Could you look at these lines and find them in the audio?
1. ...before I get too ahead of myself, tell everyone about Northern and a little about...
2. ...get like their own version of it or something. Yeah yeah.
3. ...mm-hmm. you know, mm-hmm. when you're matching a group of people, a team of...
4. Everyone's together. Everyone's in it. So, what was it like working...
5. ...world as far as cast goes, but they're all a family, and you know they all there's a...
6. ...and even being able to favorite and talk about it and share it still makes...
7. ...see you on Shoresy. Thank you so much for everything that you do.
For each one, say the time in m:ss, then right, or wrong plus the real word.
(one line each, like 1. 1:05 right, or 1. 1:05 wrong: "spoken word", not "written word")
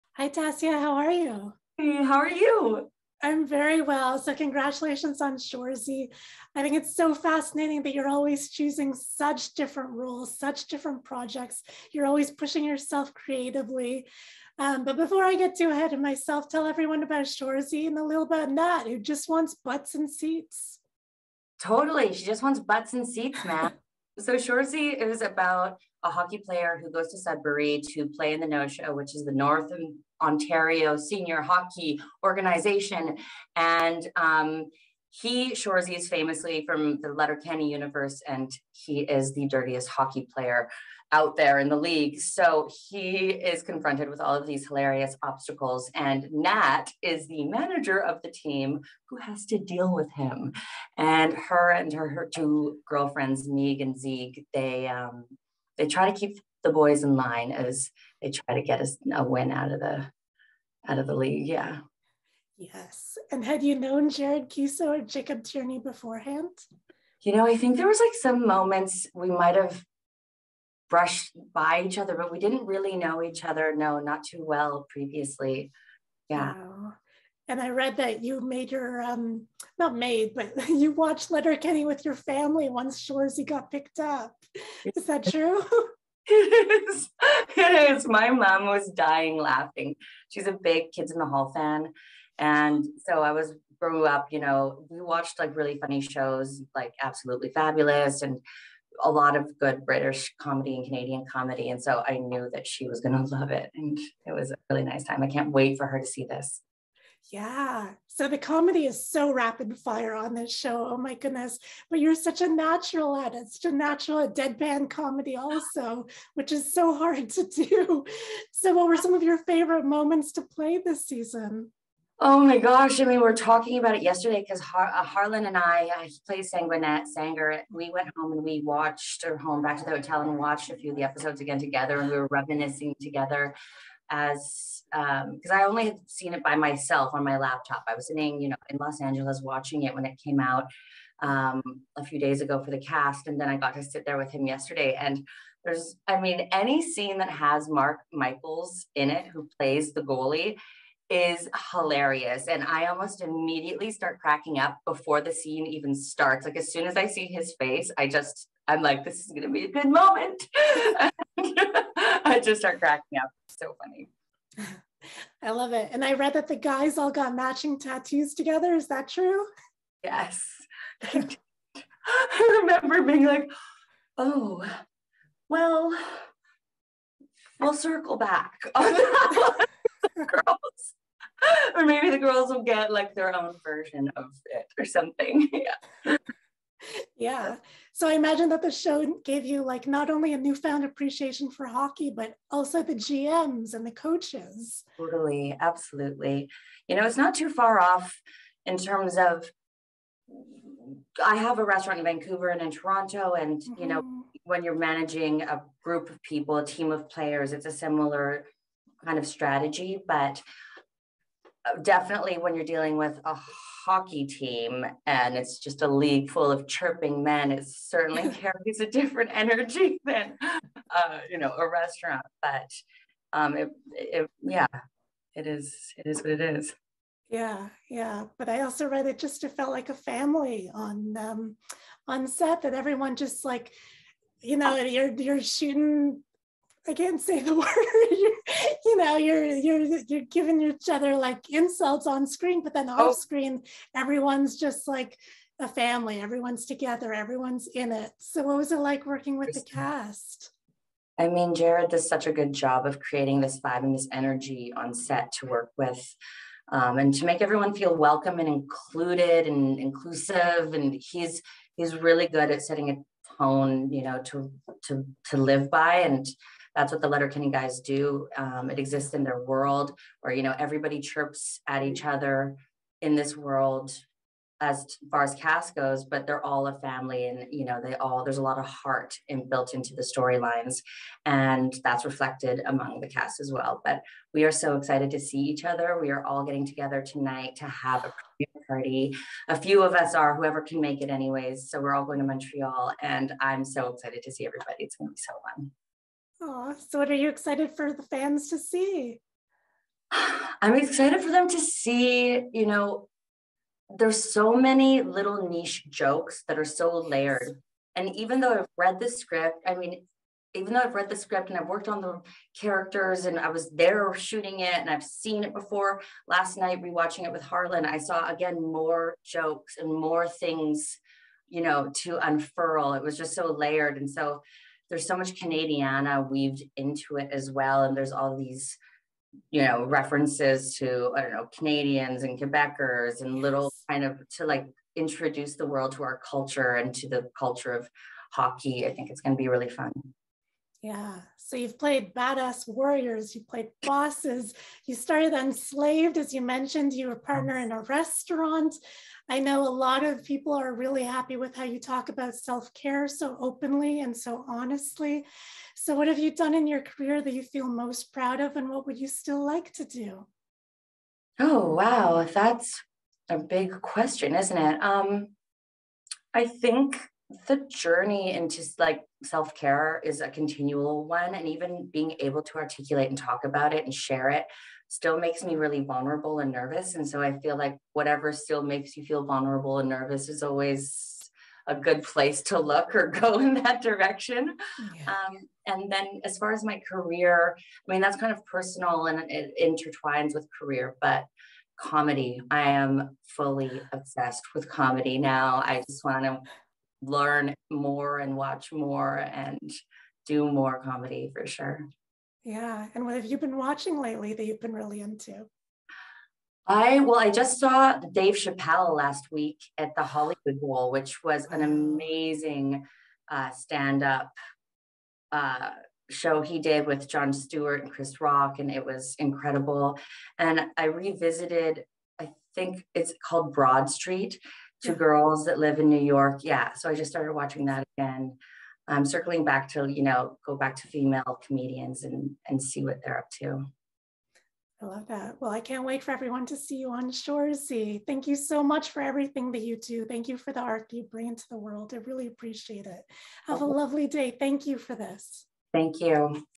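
1. 0:14 wrong: "Shoresy", not "Northern"
2. 3:02 right
3. 3:23 wrong: "managing", not "matching"
4. 4:06 right
5. 4:33 right
6. 6:11 wrong: "articulate", not "favorite"
7. 7:16 right.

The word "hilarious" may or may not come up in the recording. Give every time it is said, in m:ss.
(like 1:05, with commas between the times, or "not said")
0:44, 2:31.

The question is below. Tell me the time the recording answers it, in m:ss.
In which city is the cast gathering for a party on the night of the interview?
4:52.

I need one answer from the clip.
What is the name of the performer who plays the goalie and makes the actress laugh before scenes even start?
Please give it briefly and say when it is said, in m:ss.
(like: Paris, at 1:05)
Mark Michaels, at 2:27.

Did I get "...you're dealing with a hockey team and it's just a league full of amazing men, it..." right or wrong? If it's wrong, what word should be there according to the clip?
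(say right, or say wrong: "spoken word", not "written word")
wrong: "chirping", not "amazing".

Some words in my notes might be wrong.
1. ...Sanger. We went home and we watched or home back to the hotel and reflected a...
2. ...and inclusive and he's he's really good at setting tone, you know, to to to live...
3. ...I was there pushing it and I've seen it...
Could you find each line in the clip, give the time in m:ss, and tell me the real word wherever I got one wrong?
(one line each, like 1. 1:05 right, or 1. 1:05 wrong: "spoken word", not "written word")
1. 2:07 wrong: "watched", not "reflected"
2. 4:19 right
3. 5:13 wrong: "shooting", not "pushing".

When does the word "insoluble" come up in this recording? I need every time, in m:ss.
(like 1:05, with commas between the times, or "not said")
not said.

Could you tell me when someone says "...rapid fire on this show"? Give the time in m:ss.
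1:49.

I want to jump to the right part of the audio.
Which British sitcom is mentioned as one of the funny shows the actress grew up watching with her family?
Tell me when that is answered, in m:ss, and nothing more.
1:37.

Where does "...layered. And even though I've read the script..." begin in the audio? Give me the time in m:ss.
5:06.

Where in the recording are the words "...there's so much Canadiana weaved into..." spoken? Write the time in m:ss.
5:24.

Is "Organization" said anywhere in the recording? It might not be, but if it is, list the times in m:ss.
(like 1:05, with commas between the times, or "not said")
0:32.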